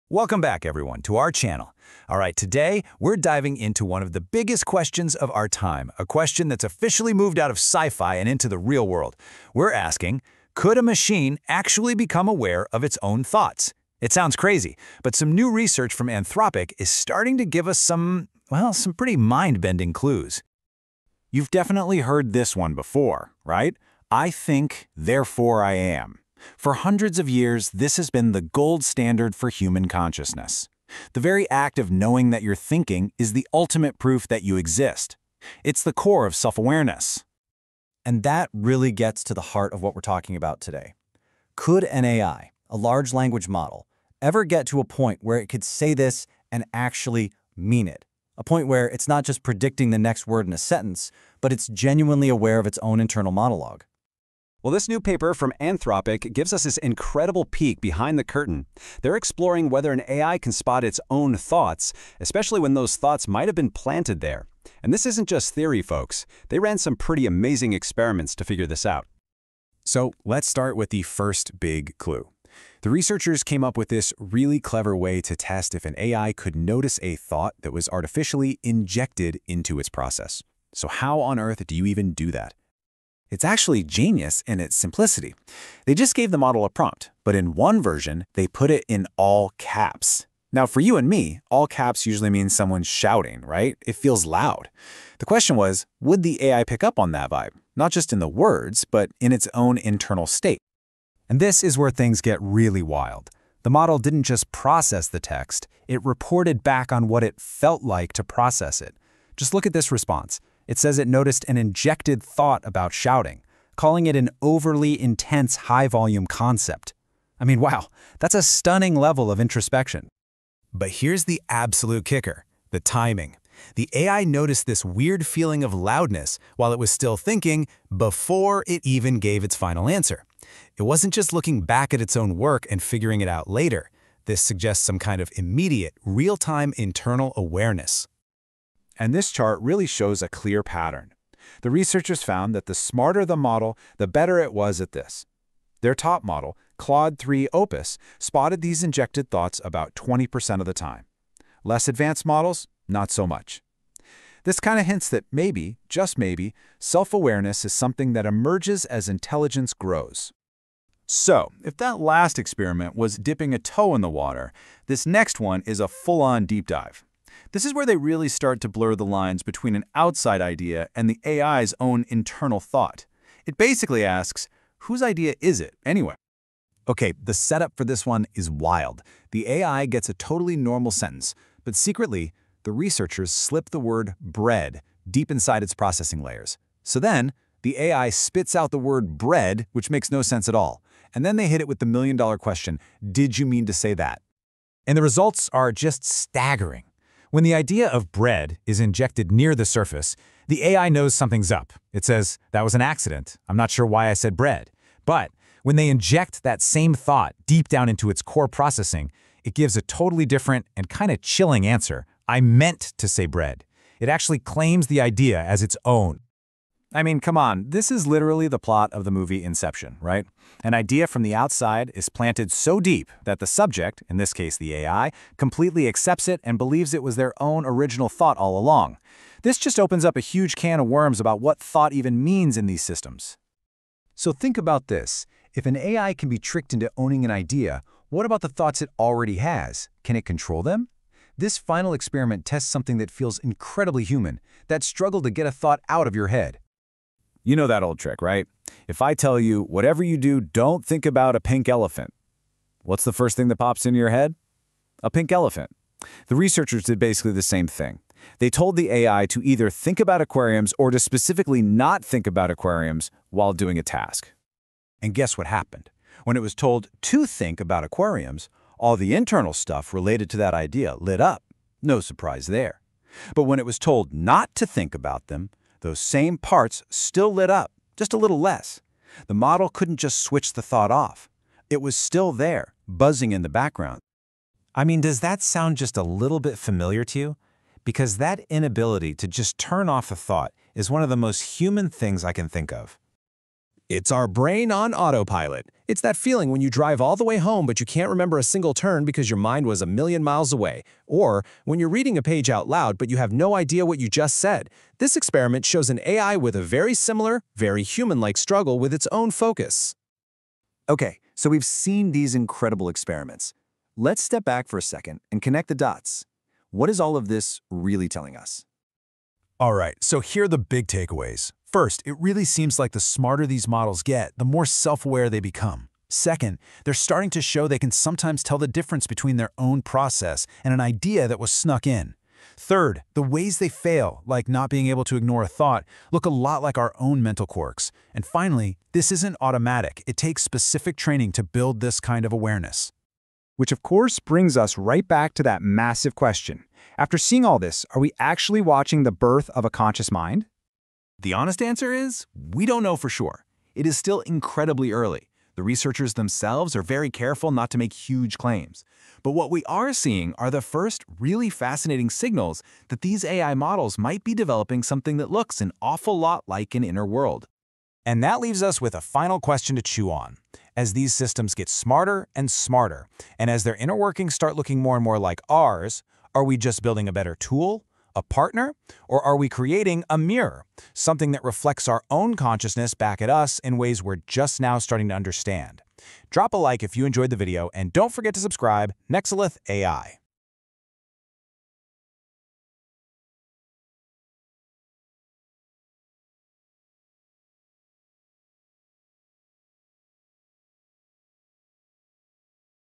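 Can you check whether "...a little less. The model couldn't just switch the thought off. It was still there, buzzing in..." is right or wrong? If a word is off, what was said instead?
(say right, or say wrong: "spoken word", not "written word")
right.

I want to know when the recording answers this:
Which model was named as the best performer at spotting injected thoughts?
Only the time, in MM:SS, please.
02:26.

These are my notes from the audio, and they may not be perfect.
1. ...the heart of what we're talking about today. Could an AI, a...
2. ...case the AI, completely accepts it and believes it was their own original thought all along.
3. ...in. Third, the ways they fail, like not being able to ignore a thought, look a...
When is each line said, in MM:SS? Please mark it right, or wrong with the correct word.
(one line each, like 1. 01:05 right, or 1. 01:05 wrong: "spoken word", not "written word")
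1. 00:39 right
2. 03:44 right
3. 05:31 right.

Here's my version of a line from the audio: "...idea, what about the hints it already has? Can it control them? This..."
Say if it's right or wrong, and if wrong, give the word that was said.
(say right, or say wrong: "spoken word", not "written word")
wrong: "thoughts", not "hints".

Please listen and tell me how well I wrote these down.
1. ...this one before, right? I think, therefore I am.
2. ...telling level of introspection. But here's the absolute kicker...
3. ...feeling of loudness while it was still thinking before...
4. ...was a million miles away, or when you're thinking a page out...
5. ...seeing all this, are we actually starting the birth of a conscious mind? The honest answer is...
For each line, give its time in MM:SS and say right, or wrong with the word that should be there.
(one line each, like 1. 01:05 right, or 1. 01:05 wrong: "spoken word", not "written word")
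1. 00:22 right
2. 01:58 wrong: "stunning", not "telling"
3. 02:05 right
4. 04:59 wrong: "reading", not "thinking"
5. 05:47 wrong: "watching", not "starting".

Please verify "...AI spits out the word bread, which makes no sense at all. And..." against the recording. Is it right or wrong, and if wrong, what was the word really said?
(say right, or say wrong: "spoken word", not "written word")
right.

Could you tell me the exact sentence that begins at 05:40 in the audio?
It takes specific training to build this kind of awareness.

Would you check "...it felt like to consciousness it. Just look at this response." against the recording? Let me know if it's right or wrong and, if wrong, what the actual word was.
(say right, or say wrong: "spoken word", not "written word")
wrong: "process", not "consciousness".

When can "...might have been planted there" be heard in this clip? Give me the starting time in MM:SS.
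01:03.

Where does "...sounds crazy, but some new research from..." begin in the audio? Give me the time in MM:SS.
00:14.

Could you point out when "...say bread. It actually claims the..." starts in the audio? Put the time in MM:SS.
03:33.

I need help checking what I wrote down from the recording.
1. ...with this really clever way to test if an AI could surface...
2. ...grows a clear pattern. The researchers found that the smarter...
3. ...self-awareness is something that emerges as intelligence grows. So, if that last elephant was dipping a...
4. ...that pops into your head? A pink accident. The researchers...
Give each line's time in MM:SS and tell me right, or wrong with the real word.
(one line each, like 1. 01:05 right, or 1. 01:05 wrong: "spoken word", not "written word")
1. 01:13 wrong: "notice", not "surface"
2. 02:19 wrong: "shows", not "grows"
3. 02:36 wrong: "experiment", not "elephant"
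4. 04:13 wrong: "elephant", not "accident".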